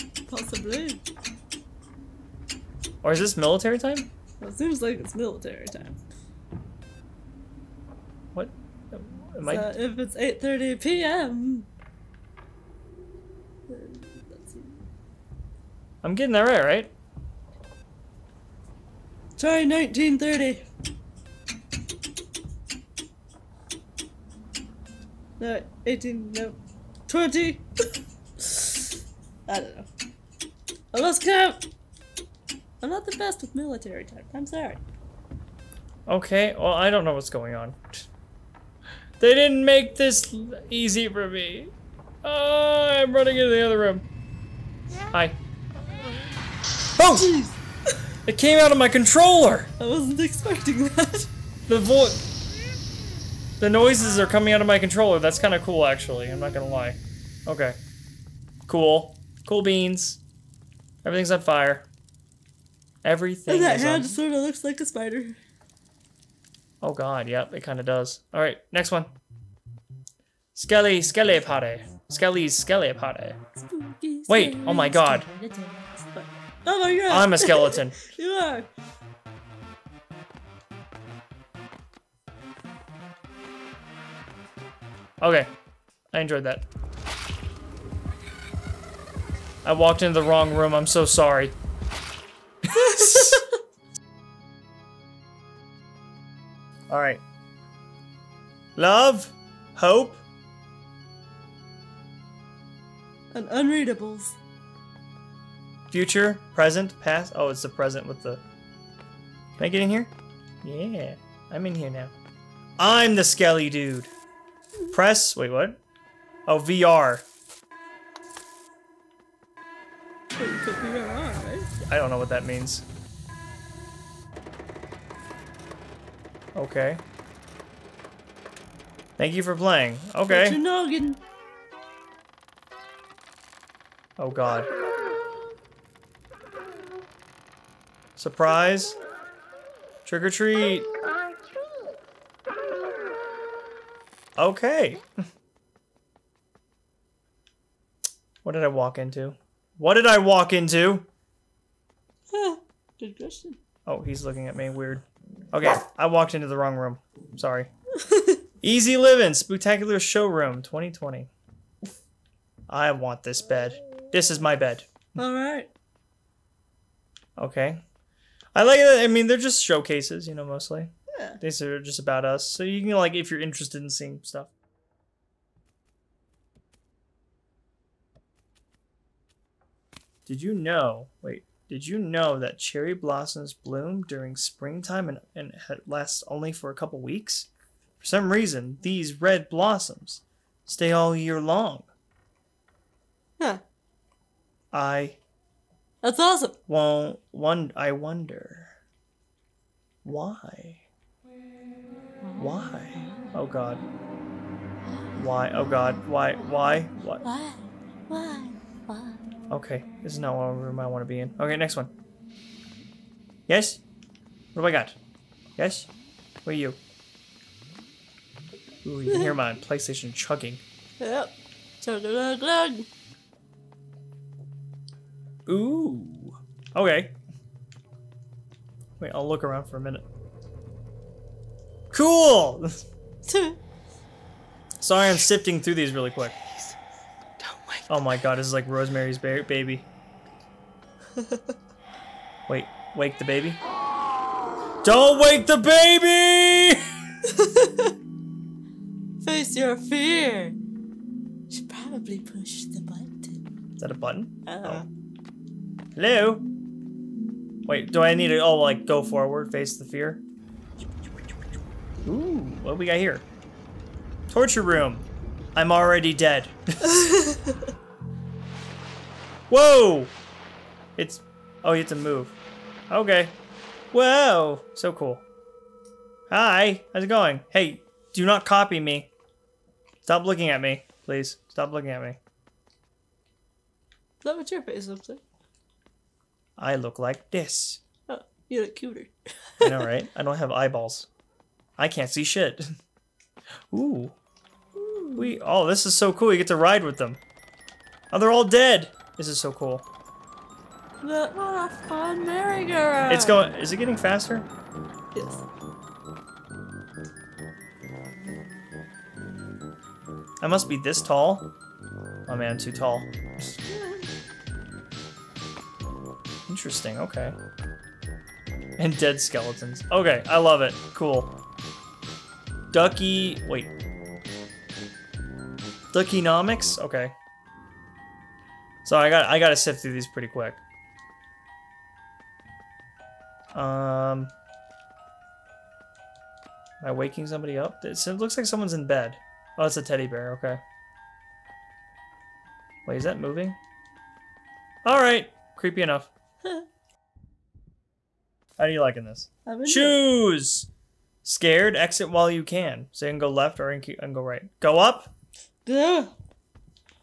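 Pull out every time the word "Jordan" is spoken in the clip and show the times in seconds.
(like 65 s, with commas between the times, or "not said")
not said.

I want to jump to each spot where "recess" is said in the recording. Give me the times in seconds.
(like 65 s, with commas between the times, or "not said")
not said.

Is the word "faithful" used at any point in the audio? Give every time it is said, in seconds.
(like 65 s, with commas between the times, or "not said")
not said.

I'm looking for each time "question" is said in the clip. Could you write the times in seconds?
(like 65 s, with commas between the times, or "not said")
153 s.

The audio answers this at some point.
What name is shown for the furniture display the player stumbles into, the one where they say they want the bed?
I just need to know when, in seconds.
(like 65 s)
158 s.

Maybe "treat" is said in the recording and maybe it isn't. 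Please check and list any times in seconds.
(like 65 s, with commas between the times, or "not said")
140 s.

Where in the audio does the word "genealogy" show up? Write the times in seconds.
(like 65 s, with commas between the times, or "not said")
not said.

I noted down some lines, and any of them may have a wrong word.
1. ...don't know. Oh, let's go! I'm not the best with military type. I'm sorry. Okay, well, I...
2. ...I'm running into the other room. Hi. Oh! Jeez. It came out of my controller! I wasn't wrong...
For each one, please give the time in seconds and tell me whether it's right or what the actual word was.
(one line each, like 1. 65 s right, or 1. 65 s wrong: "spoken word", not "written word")
1. 29 s right
2. 42 s wrong: "expecting", not "wrong".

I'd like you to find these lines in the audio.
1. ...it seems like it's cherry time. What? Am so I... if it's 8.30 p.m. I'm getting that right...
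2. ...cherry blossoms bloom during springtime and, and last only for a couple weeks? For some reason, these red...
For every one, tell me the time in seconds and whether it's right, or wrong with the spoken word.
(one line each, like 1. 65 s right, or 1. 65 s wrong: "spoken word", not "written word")
1. 4 s wrong: "military", not "cherry"
2. 182 s right.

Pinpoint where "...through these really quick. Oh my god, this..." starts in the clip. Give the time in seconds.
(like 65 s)
235 s.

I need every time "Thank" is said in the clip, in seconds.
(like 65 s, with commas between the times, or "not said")
129 s.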